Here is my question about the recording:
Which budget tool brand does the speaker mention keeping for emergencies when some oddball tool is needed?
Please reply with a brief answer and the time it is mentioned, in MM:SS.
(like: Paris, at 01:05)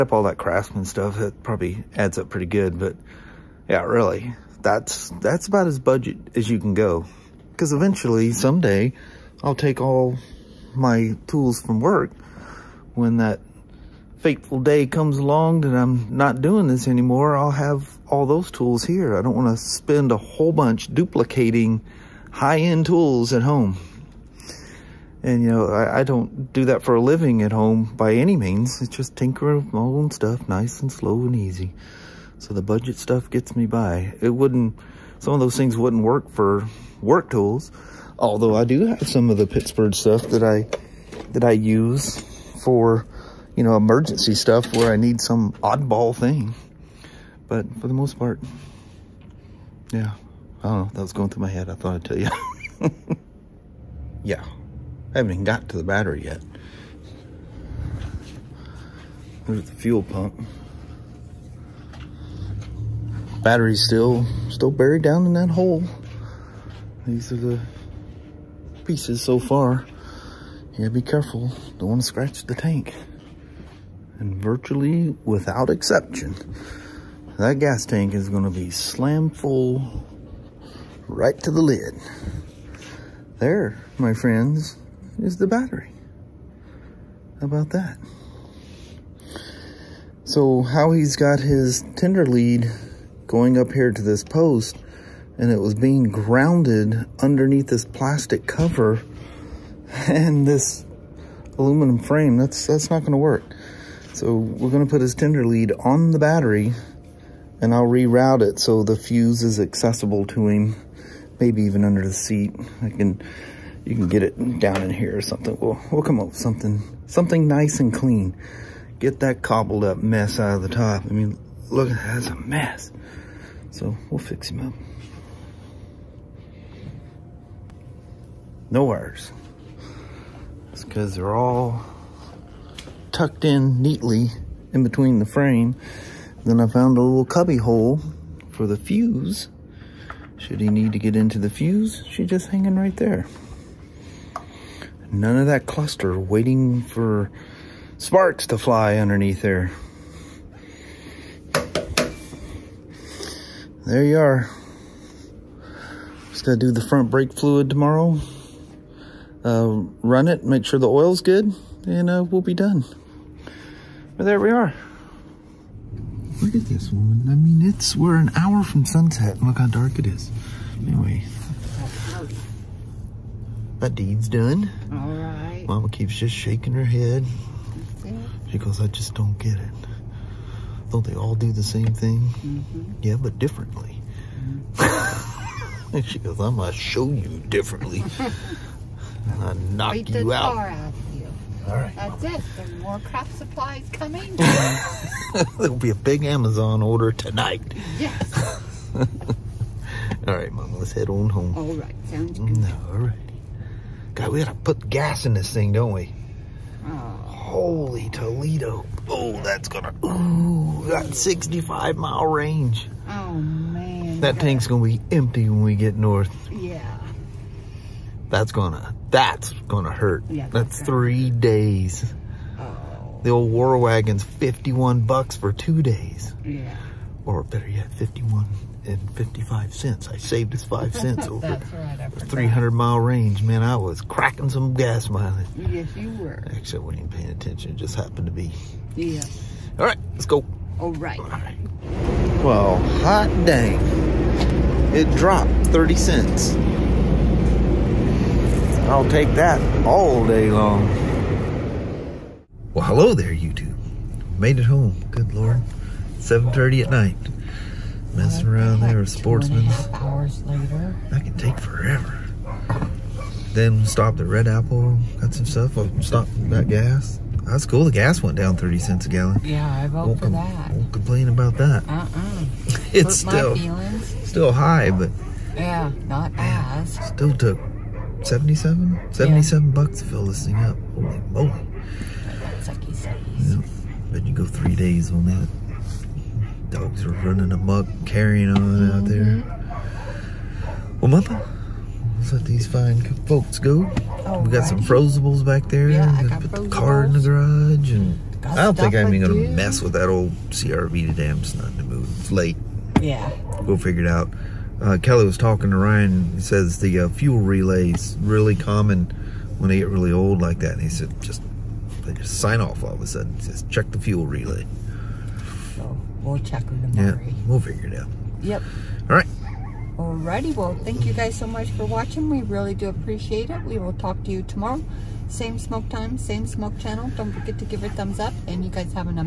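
Pittsburgh, at 00:39.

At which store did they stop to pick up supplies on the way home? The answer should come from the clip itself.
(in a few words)
Red Apple.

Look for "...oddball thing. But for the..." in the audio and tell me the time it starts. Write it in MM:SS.
00:45.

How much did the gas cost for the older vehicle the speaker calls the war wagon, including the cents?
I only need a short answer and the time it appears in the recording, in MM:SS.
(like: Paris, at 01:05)
$51.55, at 03:47.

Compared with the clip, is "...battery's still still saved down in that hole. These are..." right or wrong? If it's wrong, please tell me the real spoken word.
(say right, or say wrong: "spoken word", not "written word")
wrong: "buried", not "saved".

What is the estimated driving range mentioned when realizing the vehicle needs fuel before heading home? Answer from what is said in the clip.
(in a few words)
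65 miles.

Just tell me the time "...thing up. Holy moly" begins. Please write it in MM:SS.
04:40.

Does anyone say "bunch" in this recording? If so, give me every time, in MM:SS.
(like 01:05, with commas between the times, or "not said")
00:20.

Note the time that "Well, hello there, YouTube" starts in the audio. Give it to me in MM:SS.
04:12.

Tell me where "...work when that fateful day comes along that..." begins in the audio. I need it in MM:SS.
00:11.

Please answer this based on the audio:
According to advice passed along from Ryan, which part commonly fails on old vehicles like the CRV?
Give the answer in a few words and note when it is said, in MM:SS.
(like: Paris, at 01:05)
fuel relay, at 05:07.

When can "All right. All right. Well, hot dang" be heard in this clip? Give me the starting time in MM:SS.
04:00.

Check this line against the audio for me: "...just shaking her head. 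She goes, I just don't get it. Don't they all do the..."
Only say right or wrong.
right.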